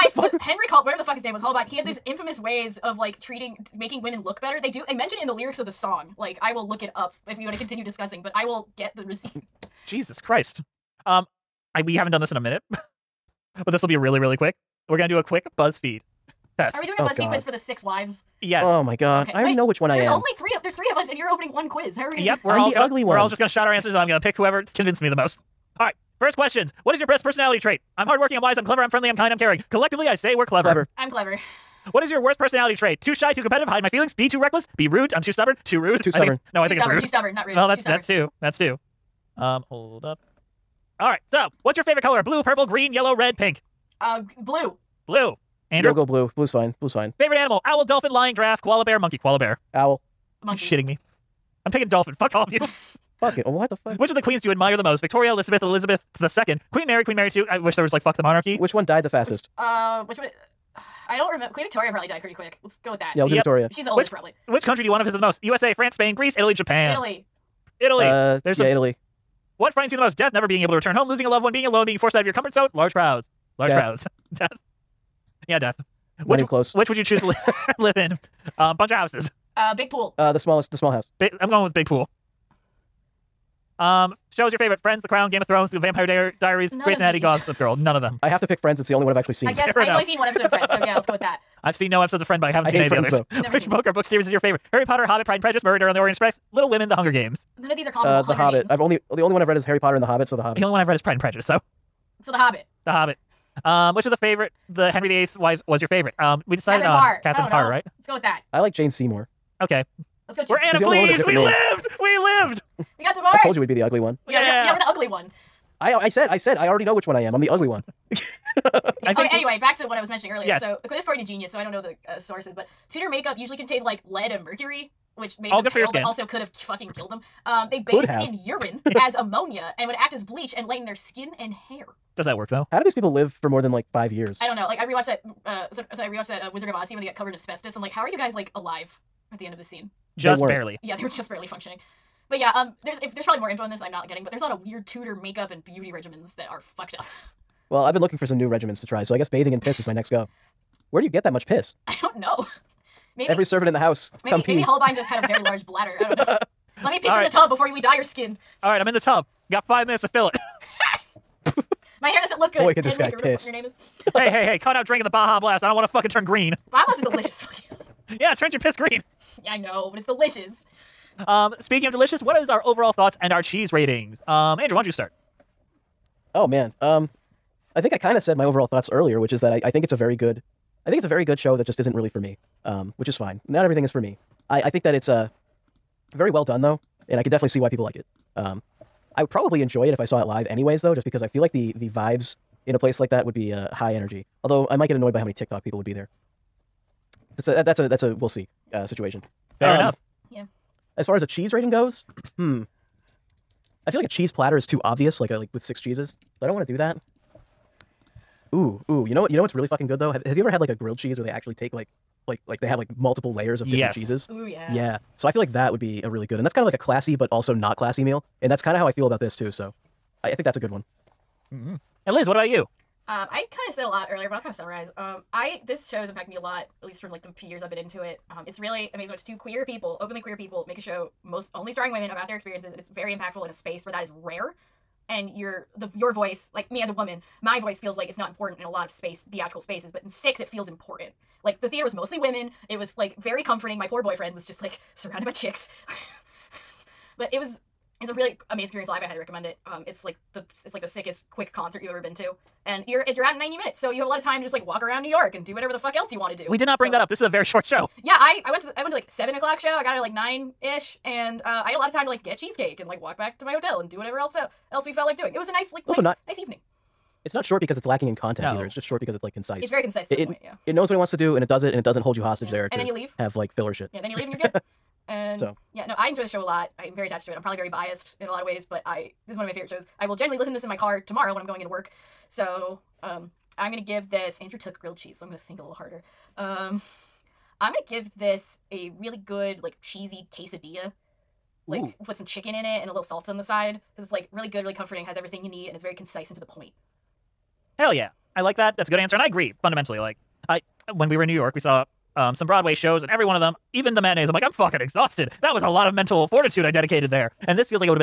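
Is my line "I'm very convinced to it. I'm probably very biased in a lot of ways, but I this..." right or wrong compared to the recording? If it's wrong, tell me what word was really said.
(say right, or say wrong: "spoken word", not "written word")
wrong: "attached", not "convinced".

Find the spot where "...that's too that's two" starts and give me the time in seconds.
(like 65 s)
37 s.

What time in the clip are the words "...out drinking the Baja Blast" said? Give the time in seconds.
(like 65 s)
164 s.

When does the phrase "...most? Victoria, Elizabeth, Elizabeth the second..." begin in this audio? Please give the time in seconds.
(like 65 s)
54 s.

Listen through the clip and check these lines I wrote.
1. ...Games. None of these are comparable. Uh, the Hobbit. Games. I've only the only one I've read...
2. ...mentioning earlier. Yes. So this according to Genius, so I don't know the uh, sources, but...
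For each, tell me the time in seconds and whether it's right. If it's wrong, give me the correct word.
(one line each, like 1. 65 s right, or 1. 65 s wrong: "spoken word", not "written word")
1. 97 s right
2. 120 s right.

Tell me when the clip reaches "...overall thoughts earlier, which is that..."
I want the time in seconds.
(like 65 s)
178 s.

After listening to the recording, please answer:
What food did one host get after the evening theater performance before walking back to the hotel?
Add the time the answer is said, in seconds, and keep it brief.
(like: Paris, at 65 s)
Cheesecake, at 262 s.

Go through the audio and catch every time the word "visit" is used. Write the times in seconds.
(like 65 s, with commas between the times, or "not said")
65 s.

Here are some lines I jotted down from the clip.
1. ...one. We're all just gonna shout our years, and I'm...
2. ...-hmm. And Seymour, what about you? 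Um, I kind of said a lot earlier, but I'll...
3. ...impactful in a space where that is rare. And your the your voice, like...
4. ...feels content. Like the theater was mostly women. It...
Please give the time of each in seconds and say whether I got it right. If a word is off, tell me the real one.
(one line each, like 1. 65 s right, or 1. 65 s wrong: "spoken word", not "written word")
1. 23 s wrong: "answers", not "years"
2. 221 s wrong: "Liz", not "Seymour"
3. 233 s right
4. 240 s wrong: "important", not "content".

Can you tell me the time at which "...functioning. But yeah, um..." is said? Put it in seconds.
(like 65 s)
141 s.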